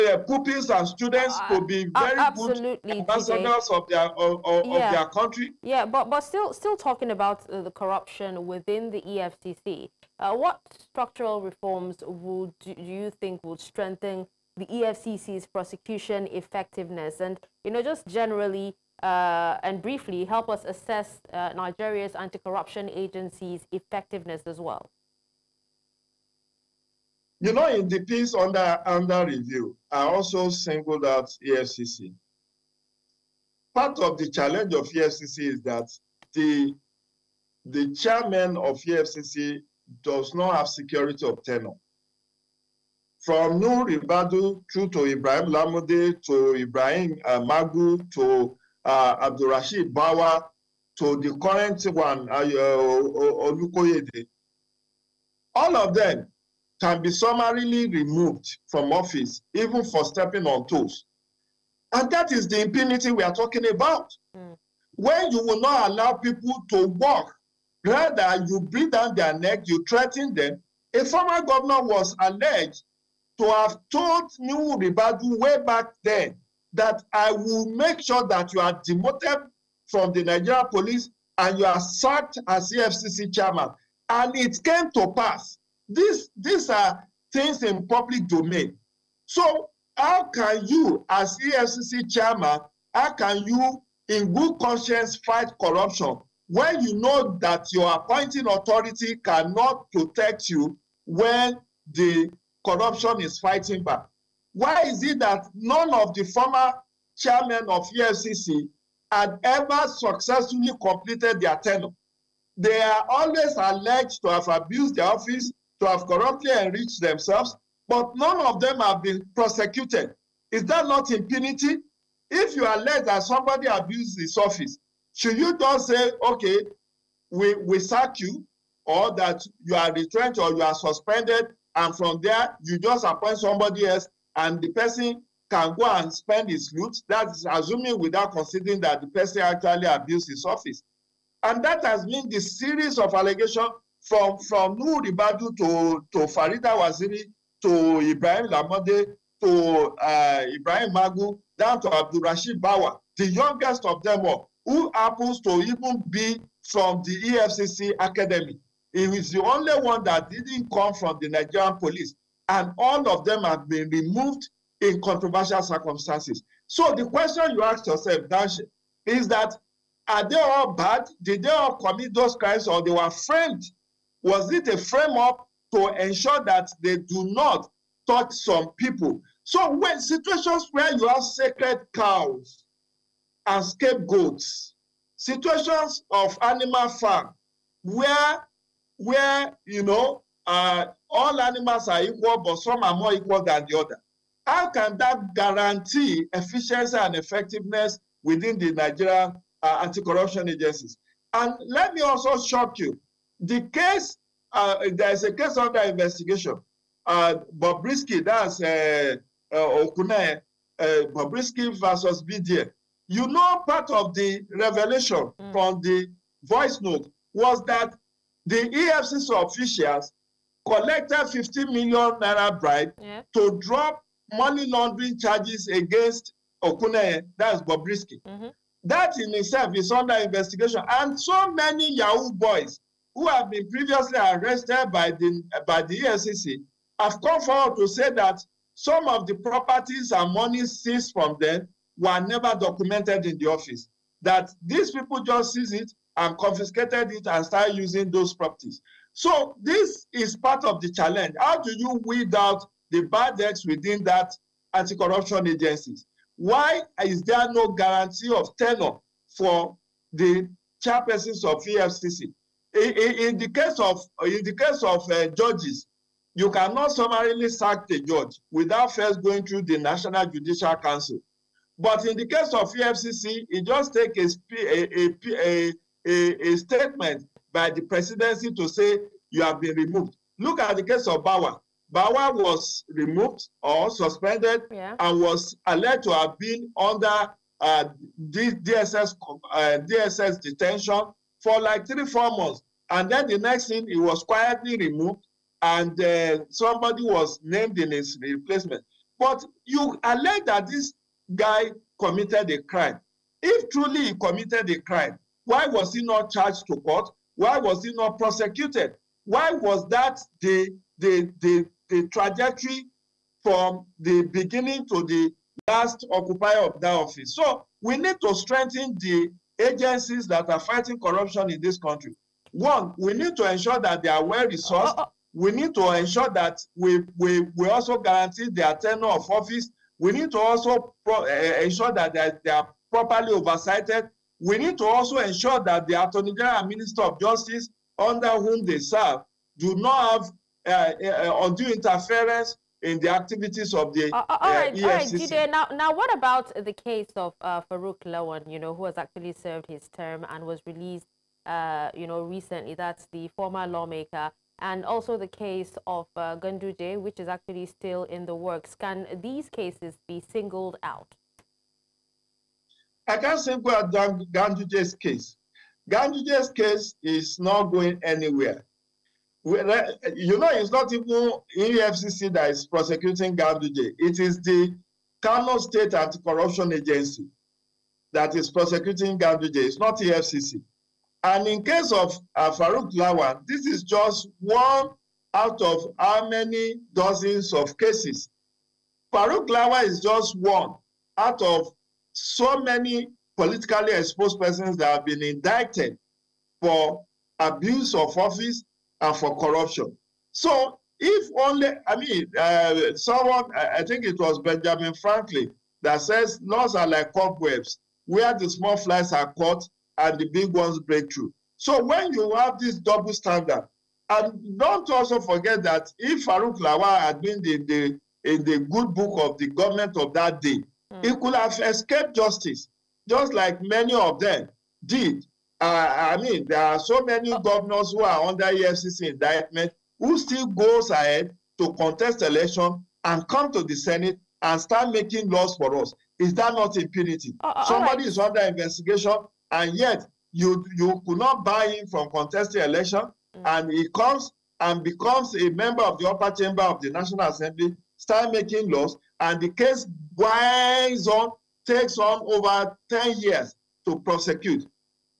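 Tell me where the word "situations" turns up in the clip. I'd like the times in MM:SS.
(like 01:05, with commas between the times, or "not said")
02:59, 03:05.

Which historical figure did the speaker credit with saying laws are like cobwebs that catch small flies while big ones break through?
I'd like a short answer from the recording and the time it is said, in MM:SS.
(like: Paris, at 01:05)
Benjamin Franklin, at 06:44.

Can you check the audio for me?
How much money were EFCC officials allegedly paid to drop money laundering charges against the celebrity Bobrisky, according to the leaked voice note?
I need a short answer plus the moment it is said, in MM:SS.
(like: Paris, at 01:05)
50 million naira, at 03:41.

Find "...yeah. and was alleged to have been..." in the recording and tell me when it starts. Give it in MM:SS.
04:44.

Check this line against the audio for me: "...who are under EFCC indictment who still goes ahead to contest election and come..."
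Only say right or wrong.
right.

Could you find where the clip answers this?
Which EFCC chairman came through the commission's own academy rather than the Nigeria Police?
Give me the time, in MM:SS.
02:31.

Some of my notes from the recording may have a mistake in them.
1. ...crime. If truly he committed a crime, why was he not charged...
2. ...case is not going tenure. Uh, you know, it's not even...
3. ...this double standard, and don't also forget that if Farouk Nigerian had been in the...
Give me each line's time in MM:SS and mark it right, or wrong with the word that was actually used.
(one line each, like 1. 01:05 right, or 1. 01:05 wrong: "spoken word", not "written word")
1. 05:02 right
2. 06:06 wrong: "anywhere", not "tenure"
3. 06:52 wrong: "Lawan", not "Nigerian".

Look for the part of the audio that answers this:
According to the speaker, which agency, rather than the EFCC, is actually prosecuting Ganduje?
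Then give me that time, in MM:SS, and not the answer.
06:15.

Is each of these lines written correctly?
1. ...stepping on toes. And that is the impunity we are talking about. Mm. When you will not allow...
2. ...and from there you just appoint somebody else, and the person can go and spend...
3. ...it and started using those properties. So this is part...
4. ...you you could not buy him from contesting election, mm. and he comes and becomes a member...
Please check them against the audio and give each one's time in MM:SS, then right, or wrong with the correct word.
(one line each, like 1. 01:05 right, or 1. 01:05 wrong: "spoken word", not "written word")
1. 01:00 right
2. 02:11 right
3. 04:07 right
4. 07:20 right.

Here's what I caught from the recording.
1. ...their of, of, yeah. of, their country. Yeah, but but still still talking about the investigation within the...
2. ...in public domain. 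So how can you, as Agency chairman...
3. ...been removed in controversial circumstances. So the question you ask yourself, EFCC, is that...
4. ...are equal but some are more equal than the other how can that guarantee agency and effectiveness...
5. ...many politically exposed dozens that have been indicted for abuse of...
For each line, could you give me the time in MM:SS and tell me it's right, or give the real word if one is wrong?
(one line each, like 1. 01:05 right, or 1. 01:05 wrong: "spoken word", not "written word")
1. 00:03 wrong: "corruption", not "investigation"
2. 01:27 wrong: "EFCC", not "Agency"
3. 02:43 wrong: "Dash", not "EFCC"
4. 03:11 wrong: "efficiency", not "agency"
5. 06:32 wrong: "persons", not "dozens".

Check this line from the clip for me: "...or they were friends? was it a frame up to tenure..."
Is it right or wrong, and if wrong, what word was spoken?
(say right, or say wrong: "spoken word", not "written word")
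wrong: "ensure", not "tenure".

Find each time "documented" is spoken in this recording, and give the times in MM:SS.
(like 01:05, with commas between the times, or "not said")
04:02.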